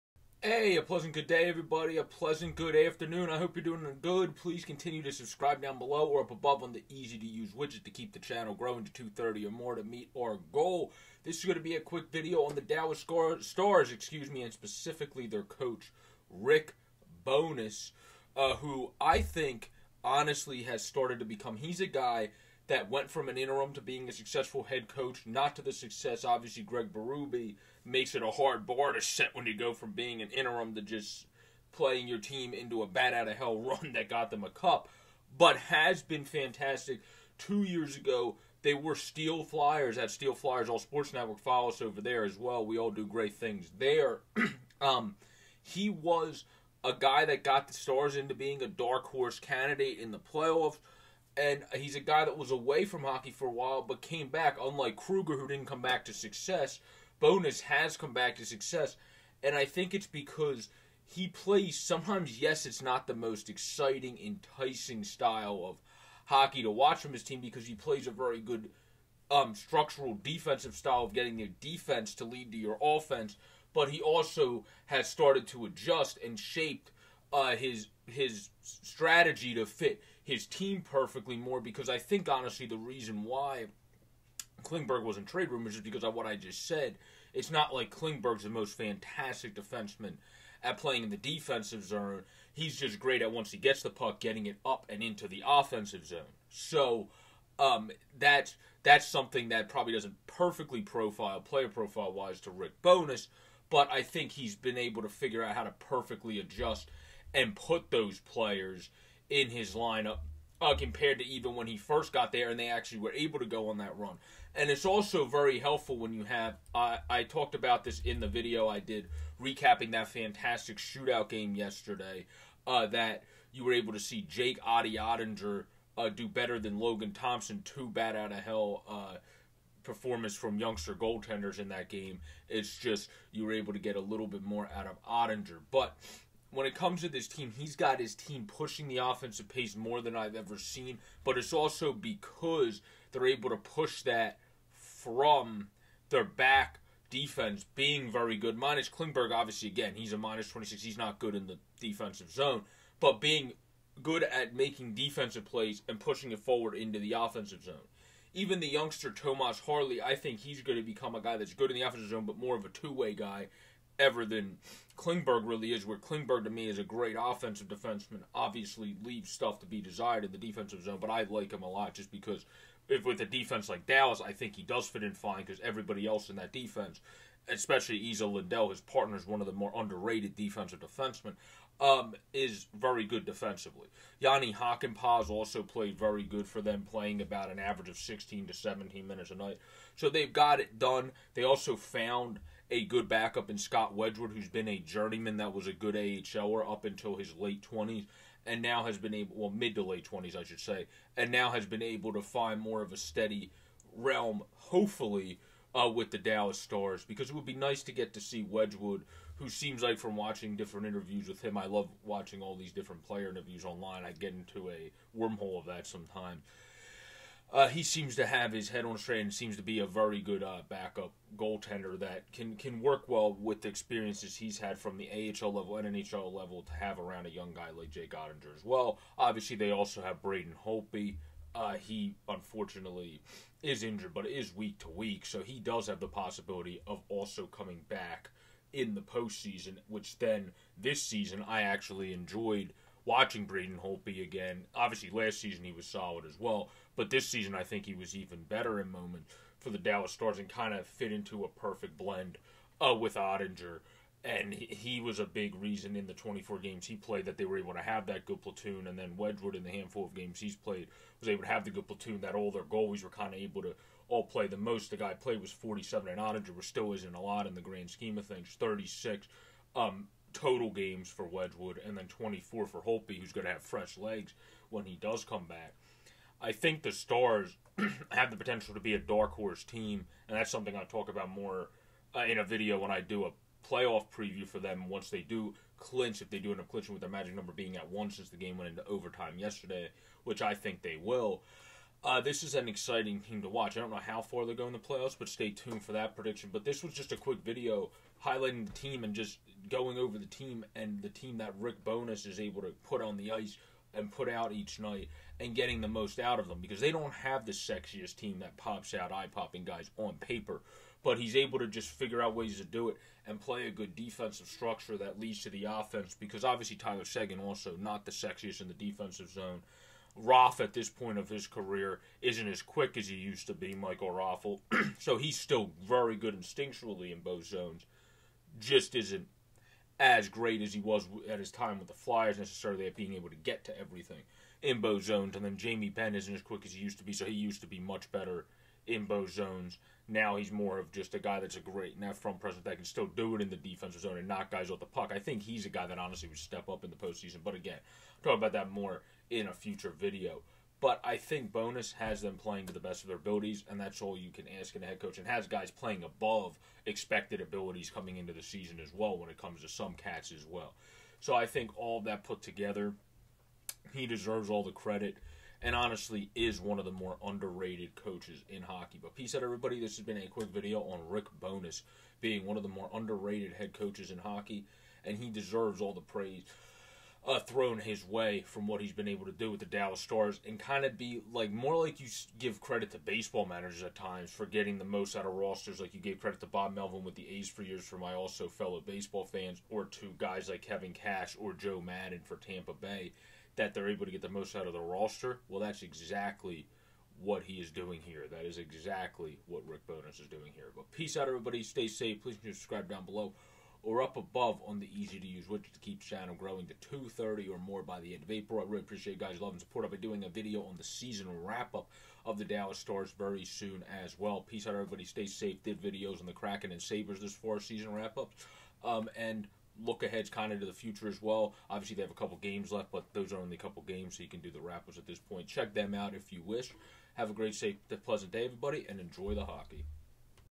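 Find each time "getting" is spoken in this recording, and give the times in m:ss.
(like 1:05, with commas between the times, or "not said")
1:11, 1:34, 5:05, 6:24.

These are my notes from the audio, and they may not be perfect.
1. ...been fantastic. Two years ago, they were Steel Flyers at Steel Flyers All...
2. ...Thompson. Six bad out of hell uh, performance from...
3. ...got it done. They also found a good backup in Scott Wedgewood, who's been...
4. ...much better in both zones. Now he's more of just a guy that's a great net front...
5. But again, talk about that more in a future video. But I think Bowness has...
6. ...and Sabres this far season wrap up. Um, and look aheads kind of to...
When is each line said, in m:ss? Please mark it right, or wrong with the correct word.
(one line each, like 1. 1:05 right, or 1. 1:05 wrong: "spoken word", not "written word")
1. 0:36 right
2. 2:07 wrong: "Two", not "Six"
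3. 3:10 right
4. 5:37 right
5. 5:47 right
6. 6:56 right.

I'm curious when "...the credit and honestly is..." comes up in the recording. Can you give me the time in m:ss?
6:04.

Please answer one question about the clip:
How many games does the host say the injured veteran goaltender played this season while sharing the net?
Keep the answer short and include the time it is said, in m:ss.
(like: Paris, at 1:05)
24, at 4:16.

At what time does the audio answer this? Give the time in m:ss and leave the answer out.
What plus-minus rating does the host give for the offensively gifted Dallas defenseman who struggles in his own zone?
2:30.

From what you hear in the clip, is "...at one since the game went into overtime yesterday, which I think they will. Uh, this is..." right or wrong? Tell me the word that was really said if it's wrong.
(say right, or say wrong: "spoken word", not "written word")
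right.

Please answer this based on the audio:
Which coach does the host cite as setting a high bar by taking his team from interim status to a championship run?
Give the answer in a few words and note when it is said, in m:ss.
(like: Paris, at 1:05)
Greg Berube, at 0:26.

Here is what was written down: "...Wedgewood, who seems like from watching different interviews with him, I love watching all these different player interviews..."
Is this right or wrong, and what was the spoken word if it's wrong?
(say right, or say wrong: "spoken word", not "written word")
right.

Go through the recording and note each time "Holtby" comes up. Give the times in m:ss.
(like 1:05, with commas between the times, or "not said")
3:50, 4:03.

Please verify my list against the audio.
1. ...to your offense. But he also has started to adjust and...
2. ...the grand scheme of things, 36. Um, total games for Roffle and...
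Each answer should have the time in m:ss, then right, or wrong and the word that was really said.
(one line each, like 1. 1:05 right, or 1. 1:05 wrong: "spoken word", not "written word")
1. 1:12 right
2. 4:27 wrong: "Wedgwood", not "Roffle".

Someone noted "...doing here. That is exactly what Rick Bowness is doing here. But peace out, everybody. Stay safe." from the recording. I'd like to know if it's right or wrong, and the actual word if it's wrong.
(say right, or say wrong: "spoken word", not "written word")
right.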